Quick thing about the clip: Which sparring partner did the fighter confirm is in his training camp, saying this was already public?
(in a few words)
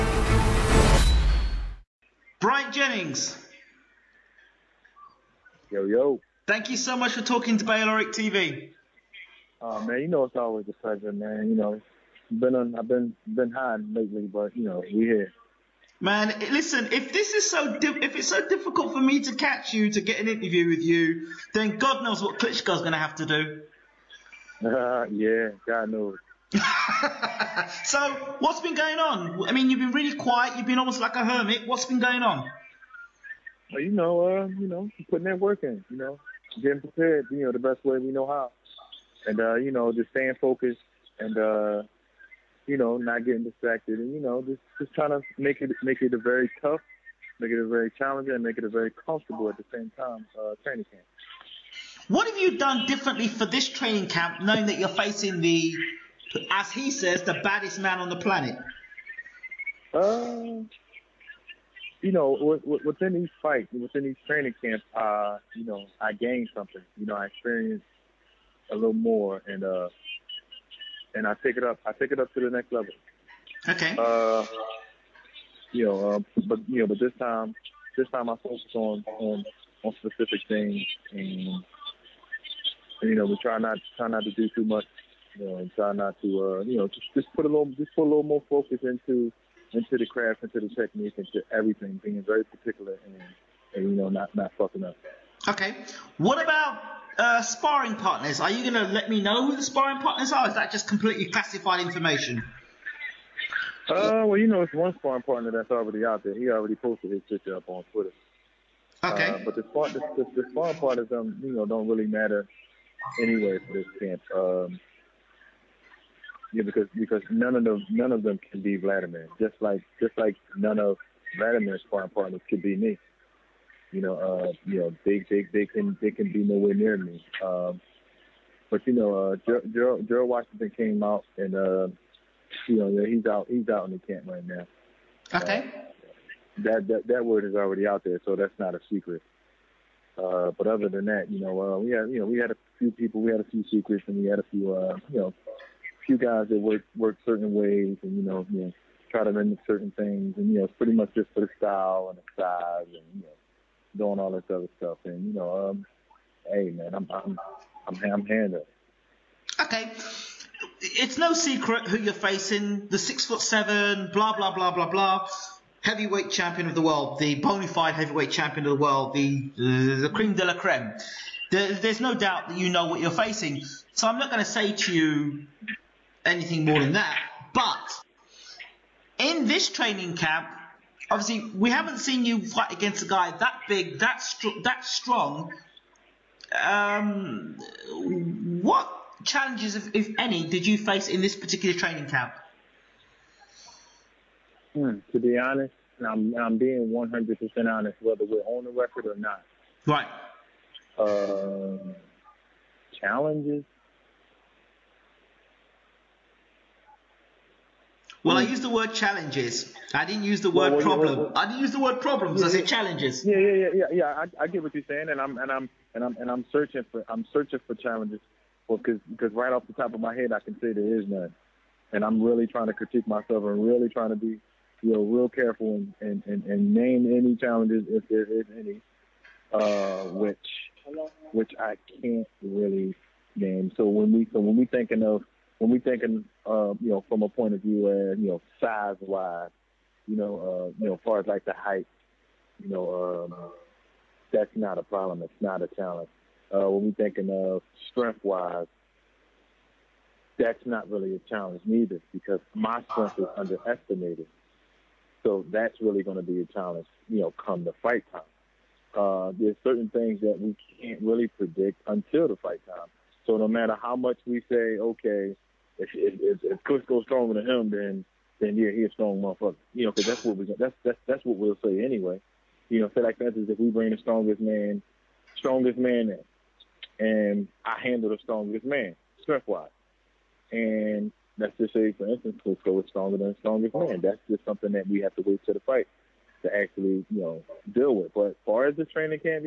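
Gerald Washington.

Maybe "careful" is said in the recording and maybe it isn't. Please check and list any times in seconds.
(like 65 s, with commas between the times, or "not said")
225 s.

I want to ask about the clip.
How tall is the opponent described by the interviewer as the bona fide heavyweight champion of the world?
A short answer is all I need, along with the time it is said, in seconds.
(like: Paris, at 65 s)
6 foot 7, at 162 s.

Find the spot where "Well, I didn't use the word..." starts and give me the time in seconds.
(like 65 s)
211 s.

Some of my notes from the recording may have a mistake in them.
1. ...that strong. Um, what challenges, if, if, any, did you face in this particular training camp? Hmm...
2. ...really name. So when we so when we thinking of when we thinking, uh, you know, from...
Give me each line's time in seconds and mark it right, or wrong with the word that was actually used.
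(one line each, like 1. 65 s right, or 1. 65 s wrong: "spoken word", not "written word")
1. 184 s right
2. 232 s right.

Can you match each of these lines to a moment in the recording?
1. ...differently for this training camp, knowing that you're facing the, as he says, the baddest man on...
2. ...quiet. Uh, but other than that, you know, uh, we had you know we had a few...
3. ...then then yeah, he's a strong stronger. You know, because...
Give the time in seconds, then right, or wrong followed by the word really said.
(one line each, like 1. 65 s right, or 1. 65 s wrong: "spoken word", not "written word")
1. 52 s right
2. 138 s wrong: "secret", not "quiet"
3. 267 s wrong: "motherfucker", not "stronger".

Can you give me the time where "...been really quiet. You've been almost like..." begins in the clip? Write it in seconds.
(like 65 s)
29 s.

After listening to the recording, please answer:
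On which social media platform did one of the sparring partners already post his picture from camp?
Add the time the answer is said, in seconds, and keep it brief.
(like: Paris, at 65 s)
Twitter, at 107 s.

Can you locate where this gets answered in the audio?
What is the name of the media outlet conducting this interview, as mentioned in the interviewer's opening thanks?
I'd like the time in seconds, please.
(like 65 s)
7 s.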